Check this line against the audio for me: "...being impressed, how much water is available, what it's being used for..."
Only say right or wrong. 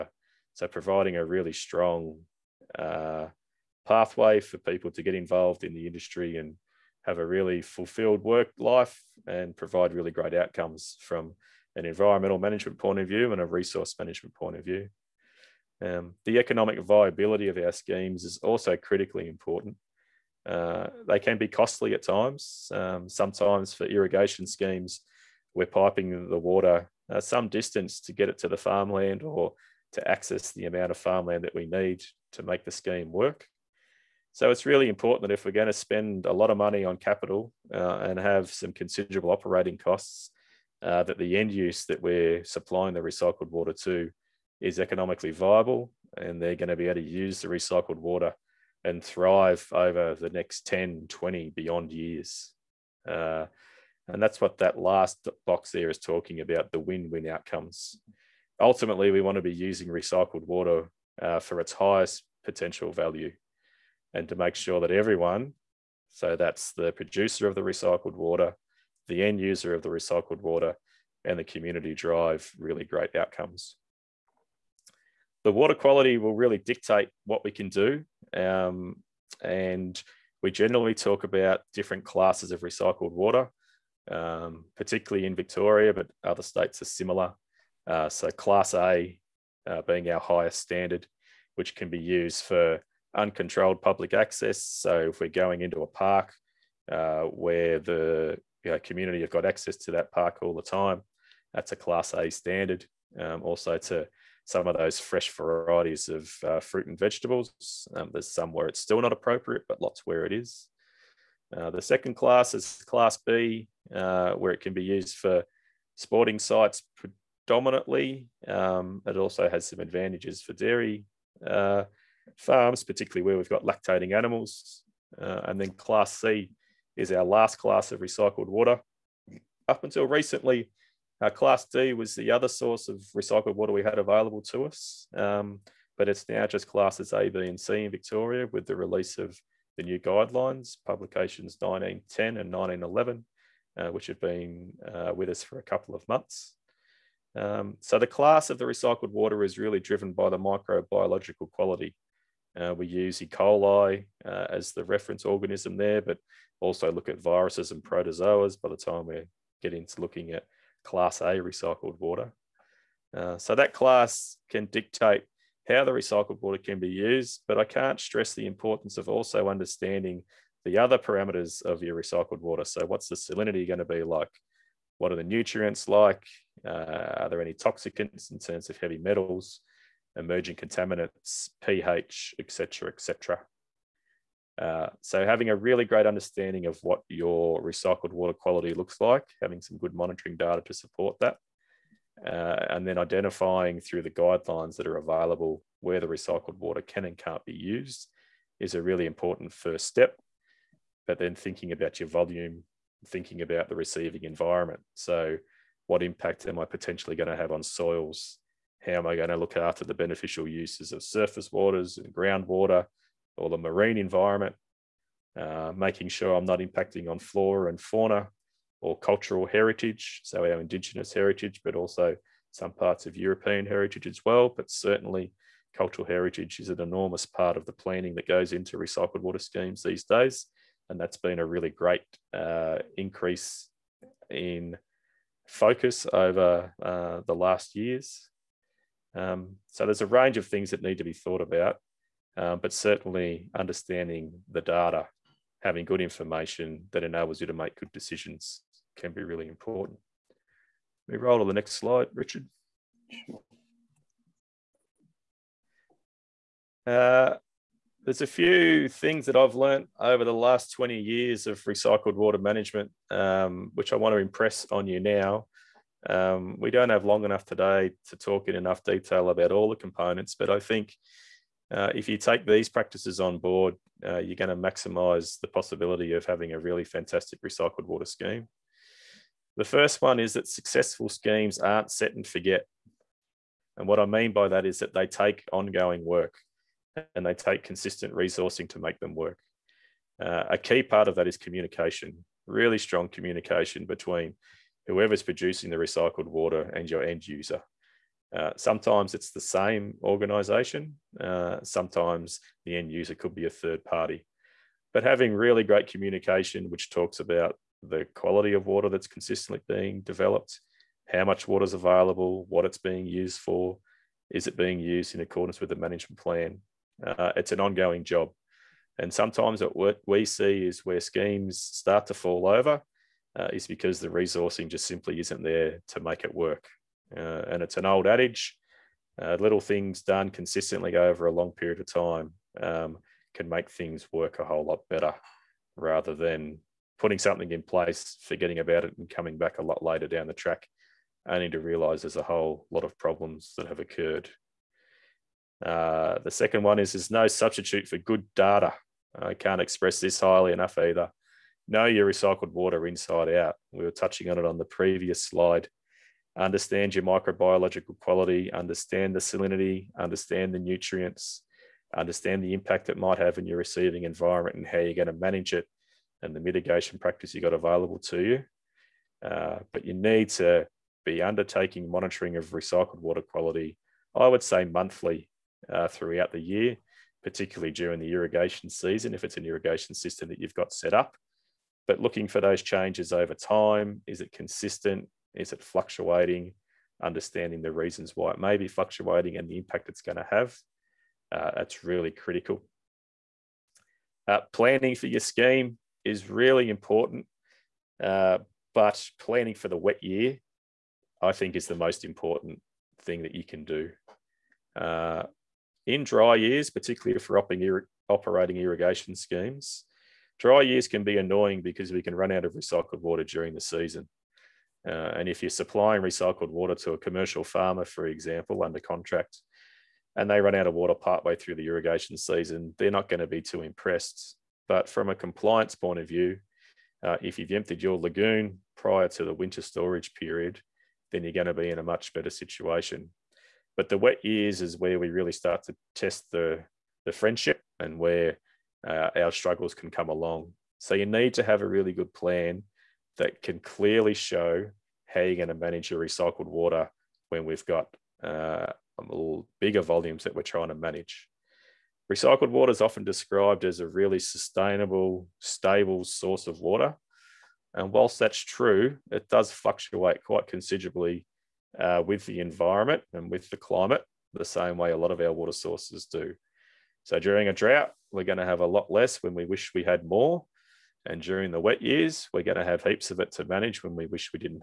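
wrong.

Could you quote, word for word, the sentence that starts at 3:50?
And that's been a really great uh, increase in focus over uh, the last years.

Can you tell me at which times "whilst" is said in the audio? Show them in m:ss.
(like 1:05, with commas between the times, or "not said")
7:37.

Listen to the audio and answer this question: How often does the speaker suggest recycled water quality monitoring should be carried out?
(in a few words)
Monthly.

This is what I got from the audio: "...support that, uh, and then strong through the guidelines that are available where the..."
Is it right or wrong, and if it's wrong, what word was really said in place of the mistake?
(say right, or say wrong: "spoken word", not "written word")
wrong: "identifying", not "strong".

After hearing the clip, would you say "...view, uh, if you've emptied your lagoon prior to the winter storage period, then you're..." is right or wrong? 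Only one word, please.
right.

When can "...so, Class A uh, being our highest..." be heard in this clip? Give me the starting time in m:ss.
1:28.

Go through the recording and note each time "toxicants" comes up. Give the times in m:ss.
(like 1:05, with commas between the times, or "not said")
2:57.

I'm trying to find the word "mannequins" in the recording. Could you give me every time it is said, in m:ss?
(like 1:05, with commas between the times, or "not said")
not said.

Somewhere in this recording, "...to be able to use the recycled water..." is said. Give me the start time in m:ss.
0:46.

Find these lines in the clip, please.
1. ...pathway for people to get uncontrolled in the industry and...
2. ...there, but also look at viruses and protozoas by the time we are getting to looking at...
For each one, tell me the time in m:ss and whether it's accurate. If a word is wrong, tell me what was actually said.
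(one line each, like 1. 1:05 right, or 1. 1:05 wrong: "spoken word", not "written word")
1. 0:03 wrong: "involved", not "uncontrolled"
2. 2:35 right.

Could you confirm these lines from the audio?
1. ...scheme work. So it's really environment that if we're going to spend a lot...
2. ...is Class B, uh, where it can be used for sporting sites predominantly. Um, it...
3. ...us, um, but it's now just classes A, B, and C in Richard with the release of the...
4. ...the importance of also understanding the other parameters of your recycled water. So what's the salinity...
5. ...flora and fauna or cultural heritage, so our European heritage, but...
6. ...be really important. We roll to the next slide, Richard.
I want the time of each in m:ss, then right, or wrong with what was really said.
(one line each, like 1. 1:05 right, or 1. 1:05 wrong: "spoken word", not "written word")
1. 0:32 wrong: "important", not "environment"
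2. 1:52 right
3. 2:14 wrong: "Victoria", not "Richard"
4. 2:48 right
5. 3:37 wrong: "Indigenous", not "European"
6. 4:09 right.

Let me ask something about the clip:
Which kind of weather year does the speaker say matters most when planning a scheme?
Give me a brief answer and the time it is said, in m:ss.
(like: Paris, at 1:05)
The wet year, at 6:39.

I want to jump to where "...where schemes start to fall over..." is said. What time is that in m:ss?
5:20.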